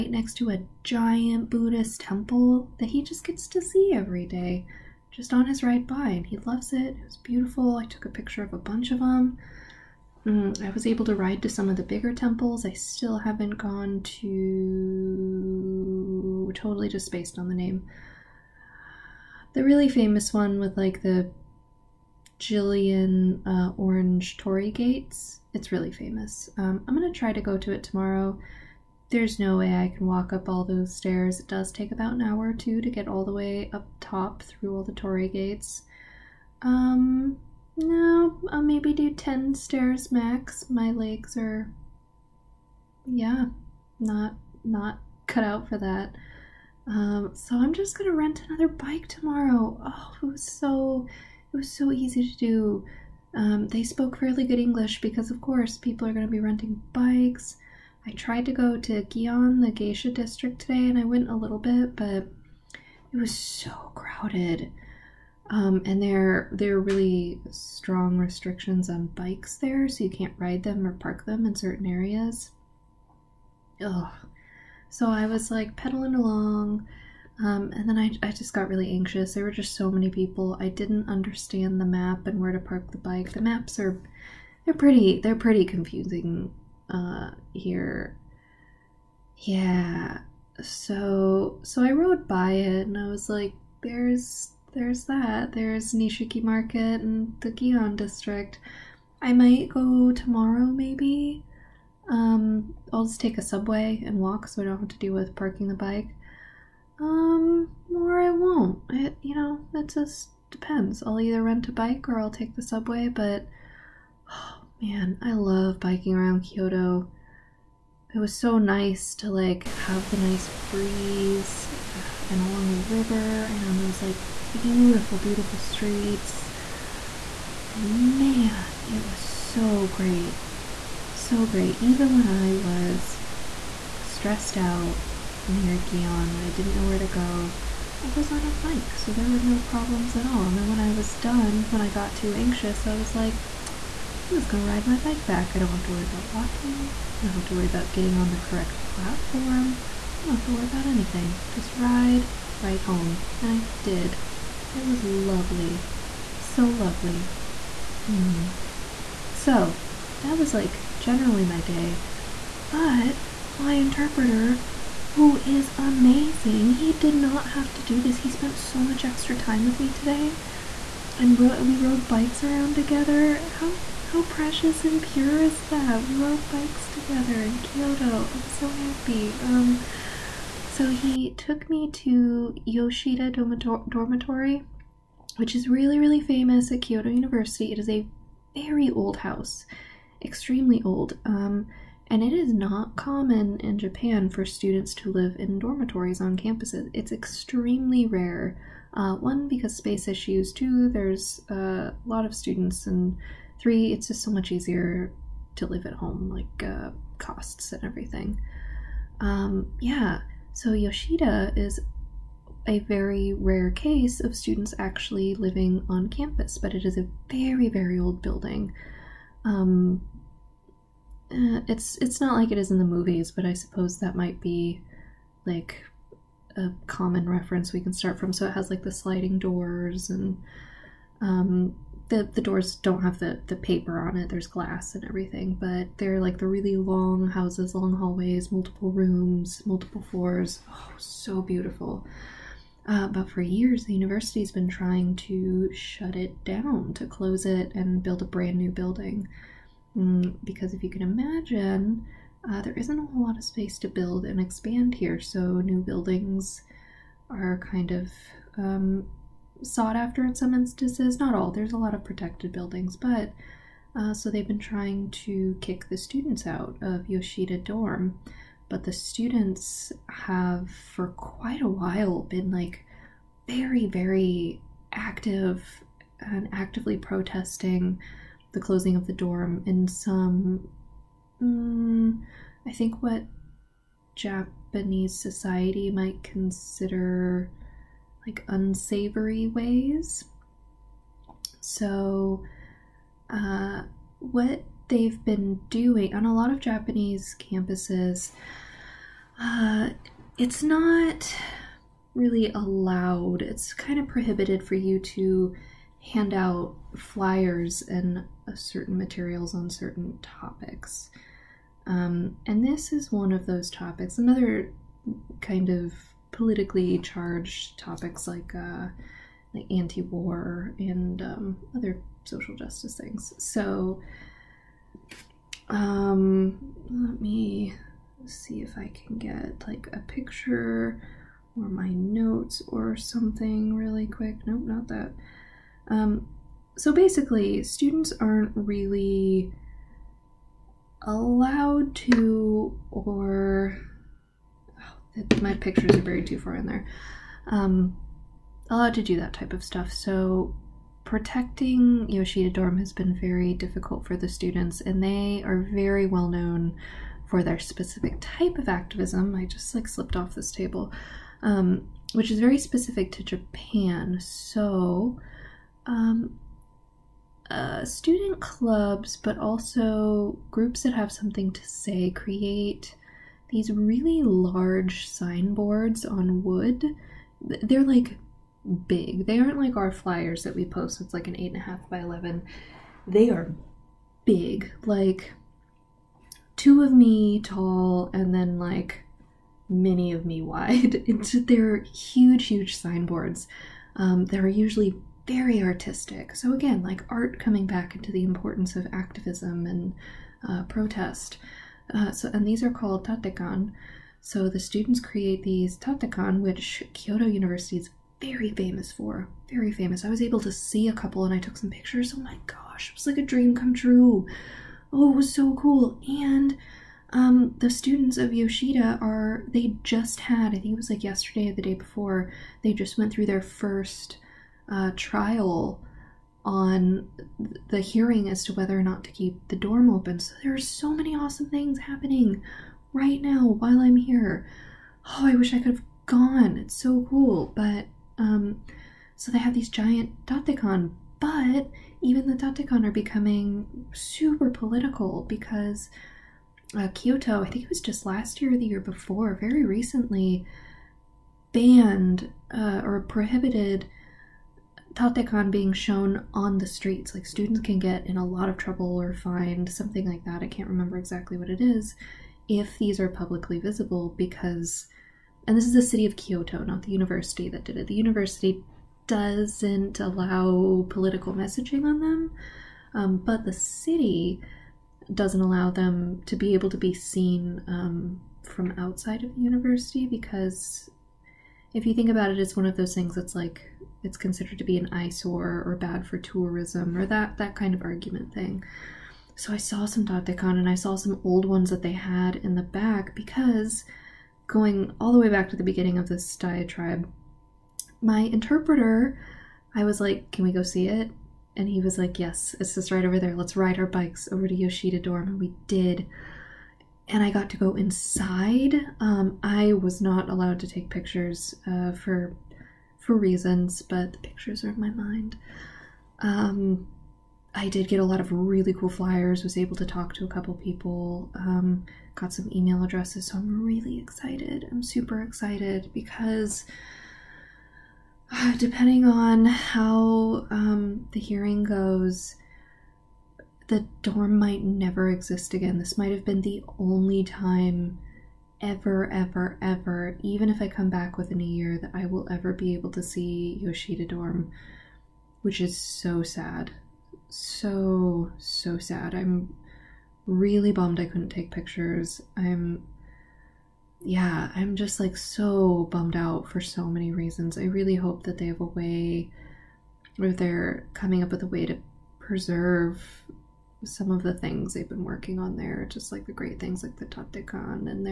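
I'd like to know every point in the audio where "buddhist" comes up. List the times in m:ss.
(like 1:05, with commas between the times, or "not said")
0:01.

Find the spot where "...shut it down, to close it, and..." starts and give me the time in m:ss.
4:05.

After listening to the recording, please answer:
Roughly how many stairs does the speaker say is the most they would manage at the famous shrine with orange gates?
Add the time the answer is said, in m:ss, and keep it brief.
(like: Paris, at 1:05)
10, at 0:39.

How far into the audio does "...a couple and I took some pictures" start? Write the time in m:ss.
6:50.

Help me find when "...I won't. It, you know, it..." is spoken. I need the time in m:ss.
1:48.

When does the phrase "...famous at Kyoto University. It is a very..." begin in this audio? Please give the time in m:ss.
3:06.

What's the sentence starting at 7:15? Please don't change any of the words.
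Oh, I wish I could have gone.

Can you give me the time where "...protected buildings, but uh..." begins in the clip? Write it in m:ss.
4:22.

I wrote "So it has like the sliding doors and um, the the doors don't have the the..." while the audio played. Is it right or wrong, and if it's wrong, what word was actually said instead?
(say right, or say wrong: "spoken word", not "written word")
right.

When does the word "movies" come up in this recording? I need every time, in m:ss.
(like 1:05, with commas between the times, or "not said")
3:42.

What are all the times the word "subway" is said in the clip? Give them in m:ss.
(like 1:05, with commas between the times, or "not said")
1:43, 1:52.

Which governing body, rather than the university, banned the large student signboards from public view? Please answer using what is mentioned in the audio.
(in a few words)
the city of Kyoto.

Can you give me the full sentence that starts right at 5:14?
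Another kind of politically charged topics like uh, like anti-war and um, other social justice things.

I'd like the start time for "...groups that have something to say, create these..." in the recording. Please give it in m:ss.
6:10.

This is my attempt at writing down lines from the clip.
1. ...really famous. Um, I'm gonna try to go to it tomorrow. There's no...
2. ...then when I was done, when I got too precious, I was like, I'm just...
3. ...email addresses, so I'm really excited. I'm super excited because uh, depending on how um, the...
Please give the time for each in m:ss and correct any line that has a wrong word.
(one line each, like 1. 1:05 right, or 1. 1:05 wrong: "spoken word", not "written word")
1. 0:25 right
2. 2:20 wrong: "anxious", not "precious"
3. 8:42 right.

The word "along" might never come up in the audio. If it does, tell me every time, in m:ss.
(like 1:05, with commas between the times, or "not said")
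1:16, 2:02.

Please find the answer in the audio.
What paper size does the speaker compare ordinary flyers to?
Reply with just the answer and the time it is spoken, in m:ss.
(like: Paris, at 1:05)
8.5 by 11, at 6:21.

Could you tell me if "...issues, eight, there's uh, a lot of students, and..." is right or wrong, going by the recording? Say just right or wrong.
wrong.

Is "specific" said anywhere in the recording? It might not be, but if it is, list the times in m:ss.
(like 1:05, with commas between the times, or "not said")
5:57, 6:02.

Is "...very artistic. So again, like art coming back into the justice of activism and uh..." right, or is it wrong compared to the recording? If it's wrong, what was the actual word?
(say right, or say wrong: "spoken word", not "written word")
wrong: "importance", not "justice".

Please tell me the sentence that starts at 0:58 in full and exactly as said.
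I tried to go to Gion, the geisha district today, and I went a little bit, but it was so crowded.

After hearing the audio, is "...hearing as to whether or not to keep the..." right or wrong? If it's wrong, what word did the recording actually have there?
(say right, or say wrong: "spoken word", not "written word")
right.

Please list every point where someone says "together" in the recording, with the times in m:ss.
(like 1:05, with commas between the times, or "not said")
2:52, 2:56.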